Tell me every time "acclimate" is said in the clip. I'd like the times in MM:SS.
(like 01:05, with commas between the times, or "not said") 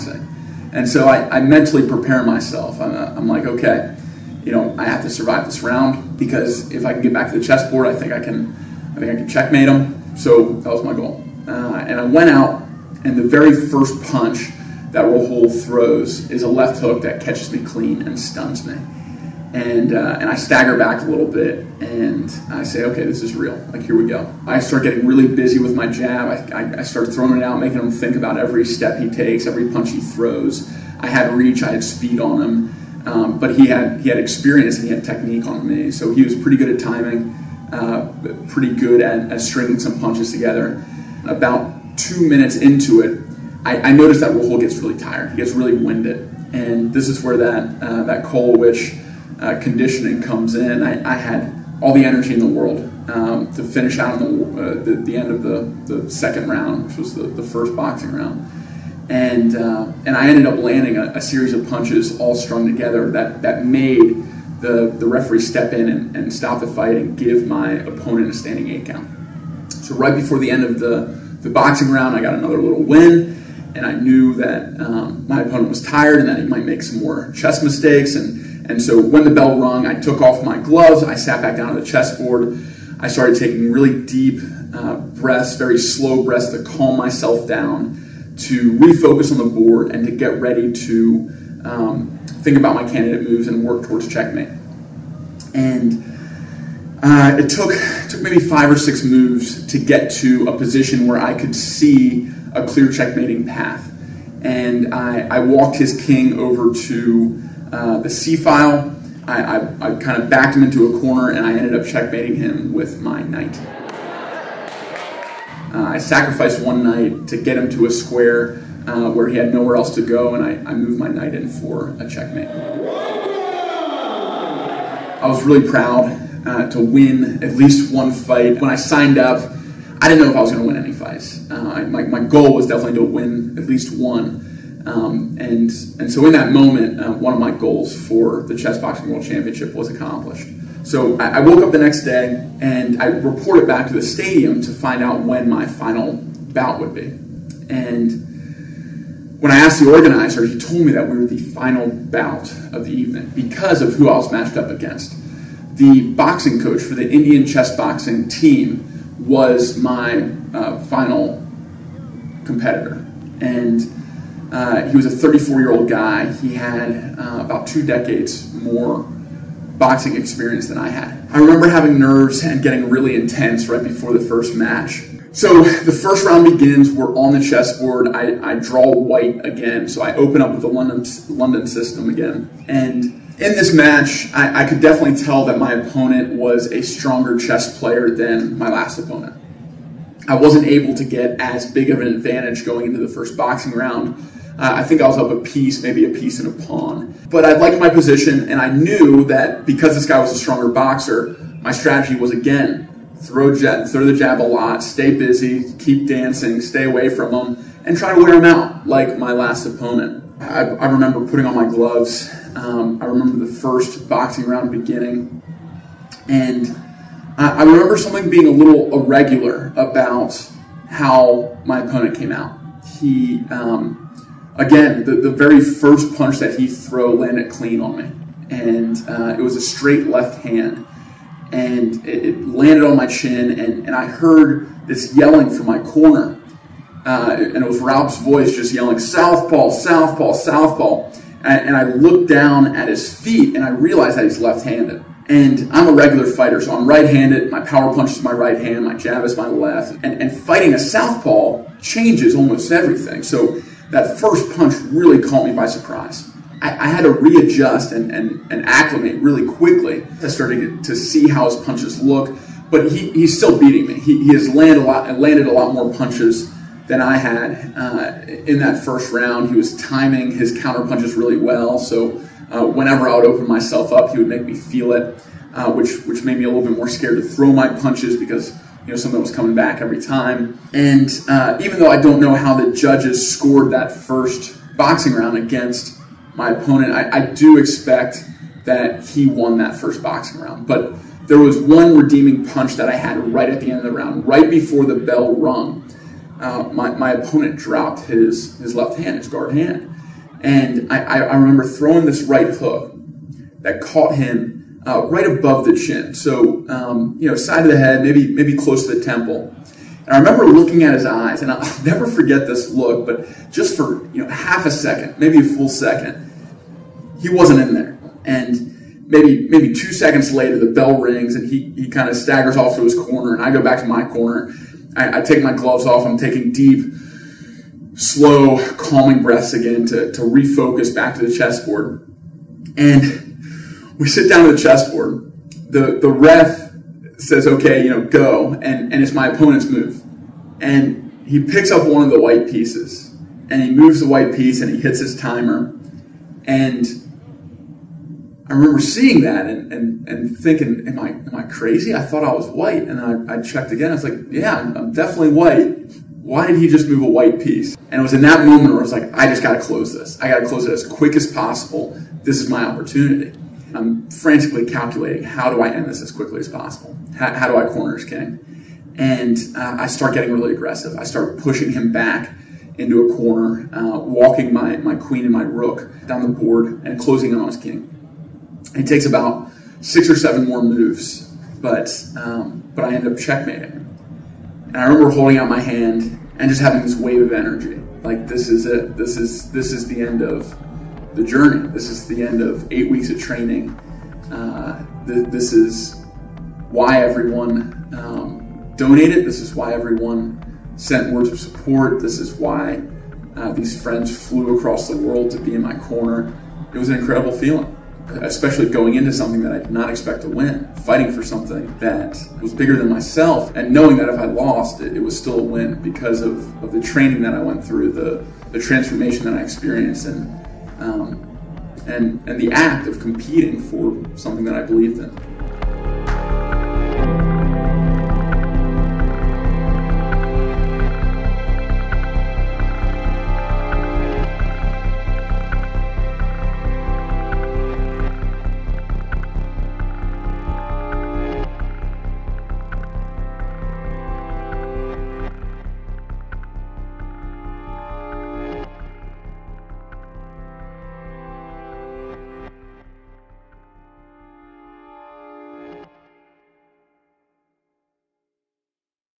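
04:18.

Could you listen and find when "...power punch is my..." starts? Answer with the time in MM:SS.
04:07.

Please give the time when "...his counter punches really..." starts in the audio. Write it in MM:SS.
04:30.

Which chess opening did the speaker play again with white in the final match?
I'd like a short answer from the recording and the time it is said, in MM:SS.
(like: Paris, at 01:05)
London system, at 03:01.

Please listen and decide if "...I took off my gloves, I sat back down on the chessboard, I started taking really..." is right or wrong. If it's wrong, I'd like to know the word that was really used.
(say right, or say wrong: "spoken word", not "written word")
right.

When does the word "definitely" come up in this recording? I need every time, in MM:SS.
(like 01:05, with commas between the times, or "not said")
02:12, 03:04, 05:54.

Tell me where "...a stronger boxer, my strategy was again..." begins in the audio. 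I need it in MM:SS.
03:20.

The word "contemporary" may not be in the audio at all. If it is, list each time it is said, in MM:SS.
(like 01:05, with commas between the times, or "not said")
not said.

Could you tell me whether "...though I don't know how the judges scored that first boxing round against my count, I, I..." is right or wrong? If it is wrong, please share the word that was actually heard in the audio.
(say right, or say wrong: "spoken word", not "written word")
wrong: "opponent", not "count".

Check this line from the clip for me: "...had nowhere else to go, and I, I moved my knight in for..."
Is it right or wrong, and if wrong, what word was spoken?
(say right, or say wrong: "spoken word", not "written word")
right.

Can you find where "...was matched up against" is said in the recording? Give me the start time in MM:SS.
02:34.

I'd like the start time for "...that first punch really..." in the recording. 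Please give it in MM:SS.
04:13.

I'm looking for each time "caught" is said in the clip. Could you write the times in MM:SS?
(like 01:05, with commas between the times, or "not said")
04:15, 05:03.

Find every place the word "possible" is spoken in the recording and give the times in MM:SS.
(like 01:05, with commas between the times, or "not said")
06:01, 06:06.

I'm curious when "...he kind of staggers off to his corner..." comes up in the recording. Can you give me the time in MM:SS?
05:21.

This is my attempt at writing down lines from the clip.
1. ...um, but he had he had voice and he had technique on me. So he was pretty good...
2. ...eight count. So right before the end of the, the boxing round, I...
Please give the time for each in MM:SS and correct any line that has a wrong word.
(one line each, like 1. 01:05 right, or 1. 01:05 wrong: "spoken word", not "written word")
1. 00:33 wrong: "experience", not "voice"
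2. 01:08 right.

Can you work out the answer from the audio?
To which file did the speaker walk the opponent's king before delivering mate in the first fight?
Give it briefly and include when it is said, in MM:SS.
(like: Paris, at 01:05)
C file, at 01:48.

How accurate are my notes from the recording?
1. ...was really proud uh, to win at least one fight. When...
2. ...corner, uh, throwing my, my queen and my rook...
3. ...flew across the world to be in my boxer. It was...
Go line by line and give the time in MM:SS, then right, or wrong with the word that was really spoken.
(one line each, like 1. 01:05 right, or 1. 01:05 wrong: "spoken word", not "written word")
1. 02:05 right
2. 06:13 wrong: "walking", not "throwing"
3. 06:44 wrong: "corner", not "boxer".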